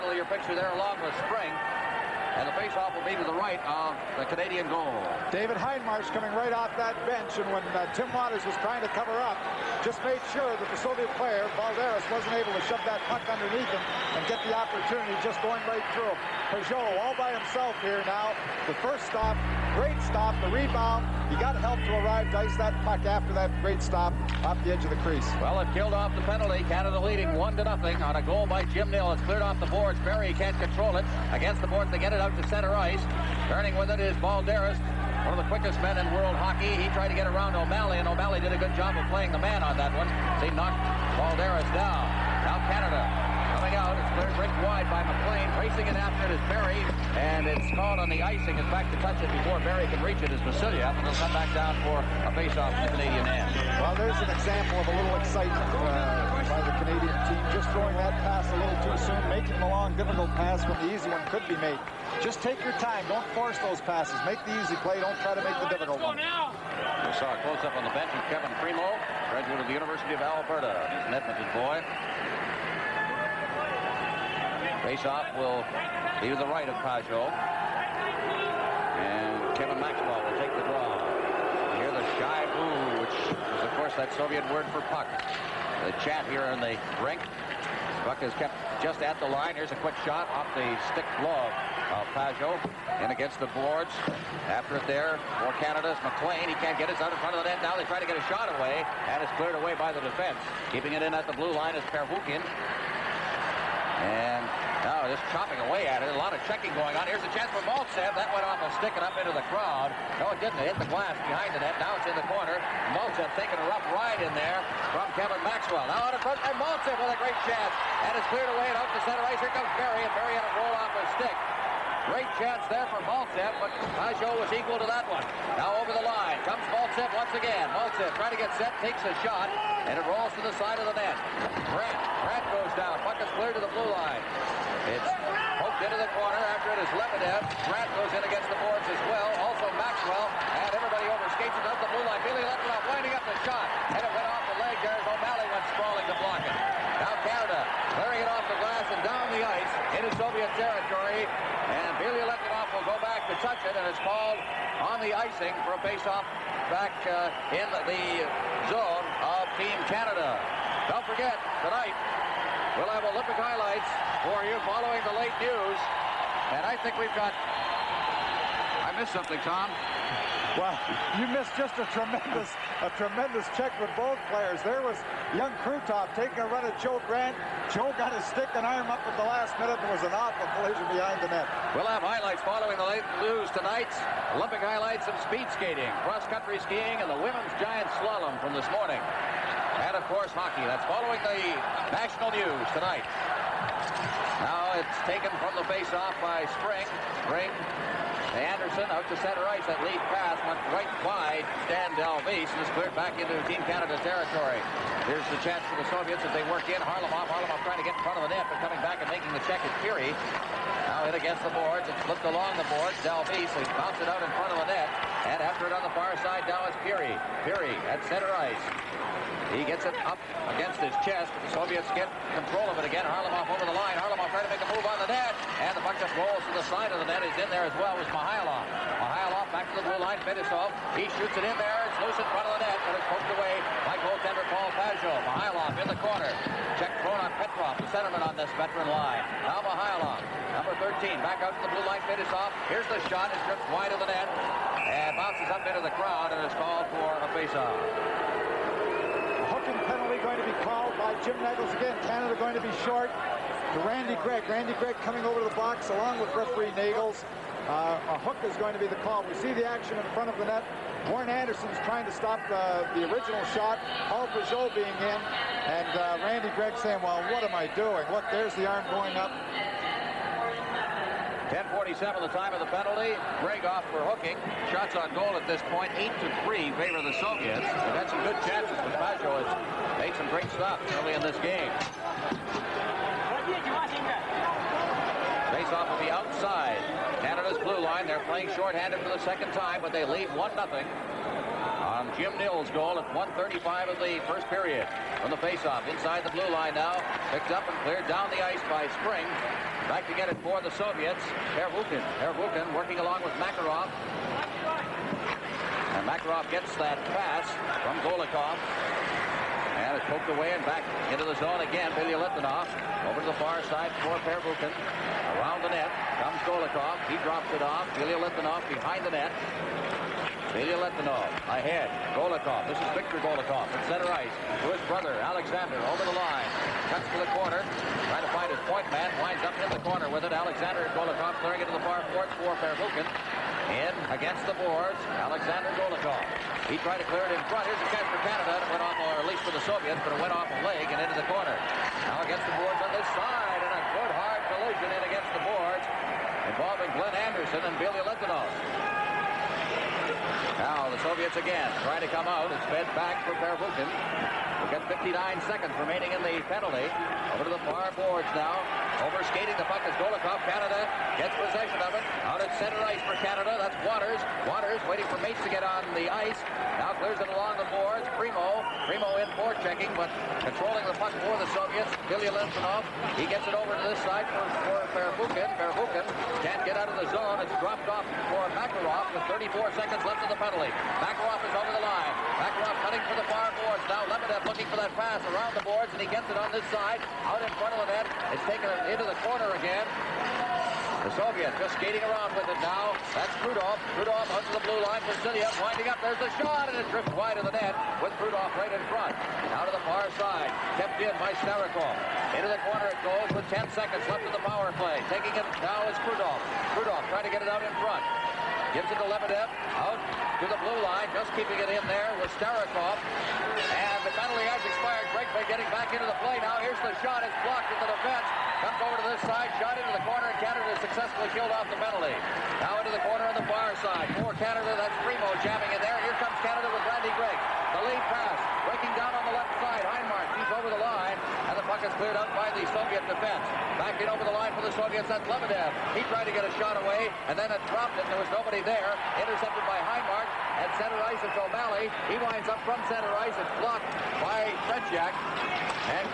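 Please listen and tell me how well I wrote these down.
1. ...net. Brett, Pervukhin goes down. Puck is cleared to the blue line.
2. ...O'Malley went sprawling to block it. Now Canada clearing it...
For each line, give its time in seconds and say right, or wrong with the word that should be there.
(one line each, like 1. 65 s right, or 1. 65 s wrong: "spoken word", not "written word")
1. 130 s wrong: "Brett", not "Pervukhin"
2. 145 s right.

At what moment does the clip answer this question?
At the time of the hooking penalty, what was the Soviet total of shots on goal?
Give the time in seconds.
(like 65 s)
275 s.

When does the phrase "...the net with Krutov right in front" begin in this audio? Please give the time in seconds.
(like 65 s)
397 s.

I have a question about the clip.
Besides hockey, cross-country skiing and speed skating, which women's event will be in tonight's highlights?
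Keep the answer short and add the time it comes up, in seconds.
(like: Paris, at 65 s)
giant slalom, at 187 s.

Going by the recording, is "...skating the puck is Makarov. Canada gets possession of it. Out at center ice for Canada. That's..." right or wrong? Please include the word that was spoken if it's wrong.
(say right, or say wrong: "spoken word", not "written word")
wrong: "Golikov", not "Makarov".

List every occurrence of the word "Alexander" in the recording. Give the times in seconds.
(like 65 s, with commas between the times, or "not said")
325 s, 330 s, 335 s.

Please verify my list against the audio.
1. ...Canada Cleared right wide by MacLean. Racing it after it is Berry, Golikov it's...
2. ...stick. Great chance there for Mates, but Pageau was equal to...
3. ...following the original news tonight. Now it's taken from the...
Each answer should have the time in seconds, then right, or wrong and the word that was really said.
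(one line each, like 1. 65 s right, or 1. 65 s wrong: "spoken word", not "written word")
1. 42 s wrong: "And", not "Golikov"
2. 121 s wrong: "Maltsev", not "Mates"
3. 190 s wrong: "national", not "original".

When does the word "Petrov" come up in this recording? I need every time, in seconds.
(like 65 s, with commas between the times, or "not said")
237 s.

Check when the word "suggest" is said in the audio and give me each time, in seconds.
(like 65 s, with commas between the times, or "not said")
not said.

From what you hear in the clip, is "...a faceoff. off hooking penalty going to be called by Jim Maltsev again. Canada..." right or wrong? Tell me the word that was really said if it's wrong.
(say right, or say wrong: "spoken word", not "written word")
wrong: "Nagels", not "Maltsev".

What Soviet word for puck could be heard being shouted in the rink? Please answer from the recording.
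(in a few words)
shaiba.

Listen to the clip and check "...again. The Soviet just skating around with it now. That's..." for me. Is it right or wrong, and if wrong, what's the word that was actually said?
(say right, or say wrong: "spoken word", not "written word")
right.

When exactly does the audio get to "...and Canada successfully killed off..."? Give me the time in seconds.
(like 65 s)
420 s.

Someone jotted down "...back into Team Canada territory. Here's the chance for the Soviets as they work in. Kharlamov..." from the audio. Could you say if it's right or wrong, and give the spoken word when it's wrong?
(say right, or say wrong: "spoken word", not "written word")
right.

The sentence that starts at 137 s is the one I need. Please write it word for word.
Grant goes in against the boards as well.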